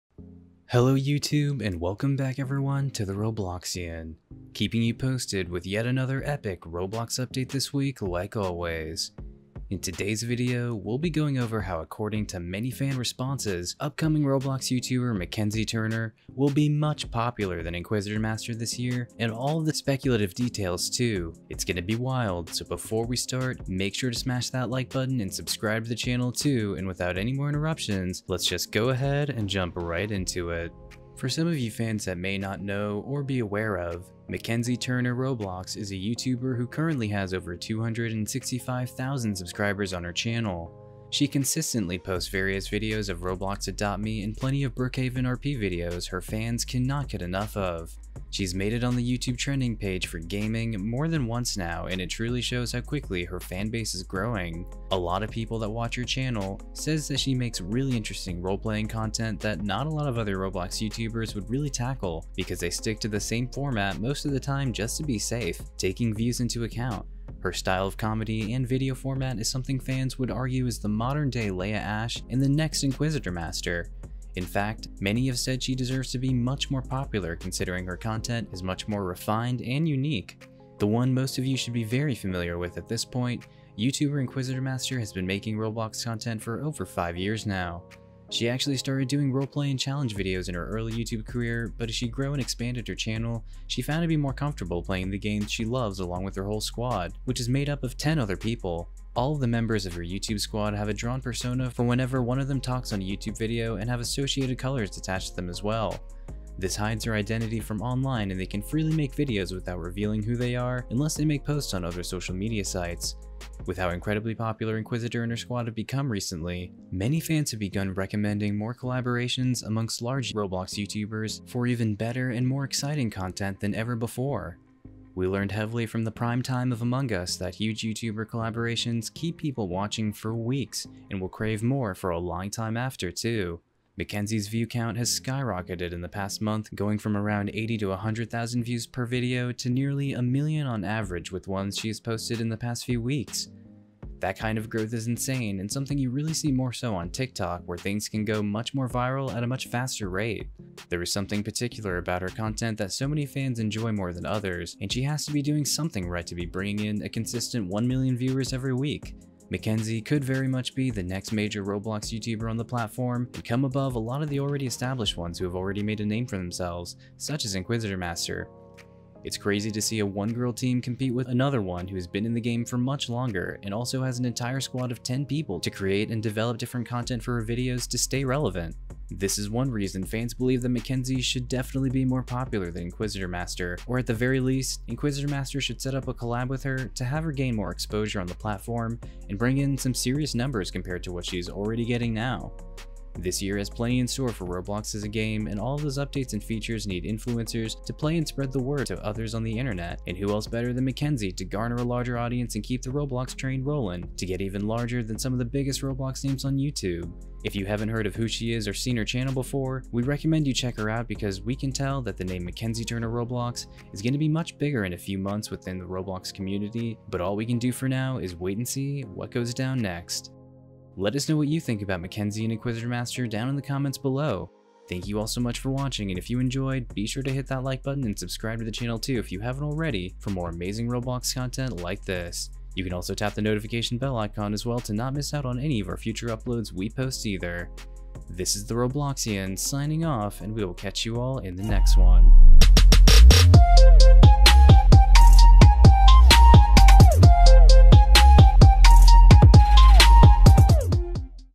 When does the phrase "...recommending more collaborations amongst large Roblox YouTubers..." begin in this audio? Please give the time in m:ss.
1:57.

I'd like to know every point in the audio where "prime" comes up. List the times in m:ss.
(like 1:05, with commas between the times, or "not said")
2:06.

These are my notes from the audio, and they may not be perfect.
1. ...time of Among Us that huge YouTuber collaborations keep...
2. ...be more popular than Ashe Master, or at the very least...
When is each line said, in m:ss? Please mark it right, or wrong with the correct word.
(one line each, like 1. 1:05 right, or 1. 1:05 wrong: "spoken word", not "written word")
1. 2:06 right
2. 3:01 wrong: "Inquisitor", not "Ashe".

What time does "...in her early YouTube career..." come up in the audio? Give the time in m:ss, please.
1:30.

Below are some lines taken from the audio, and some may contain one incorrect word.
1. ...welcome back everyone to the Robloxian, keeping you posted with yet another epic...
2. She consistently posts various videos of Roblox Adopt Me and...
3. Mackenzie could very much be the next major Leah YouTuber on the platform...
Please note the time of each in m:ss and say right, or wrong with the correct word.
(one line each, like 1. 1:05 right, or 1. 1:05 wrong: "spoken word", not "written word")
1. 0:01 right
2. 0:41 right
3. 2:39 wrong: "Roblox", not "Leah".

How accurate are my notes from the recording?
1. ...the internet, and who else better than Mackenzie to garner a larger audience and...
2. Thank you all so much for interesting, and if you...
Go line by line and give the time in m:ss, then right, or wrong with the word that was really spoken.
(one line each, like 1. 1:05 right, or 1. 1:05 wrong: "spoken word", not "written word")
1. 3:19 right
2. 3:44 wrong: "watching", not "interesting".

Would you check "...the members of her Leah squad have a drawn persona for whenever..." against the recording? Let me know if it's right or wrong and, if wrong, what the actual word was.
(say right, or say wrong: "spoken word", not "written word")
wrong: "YouTube", not "Leah".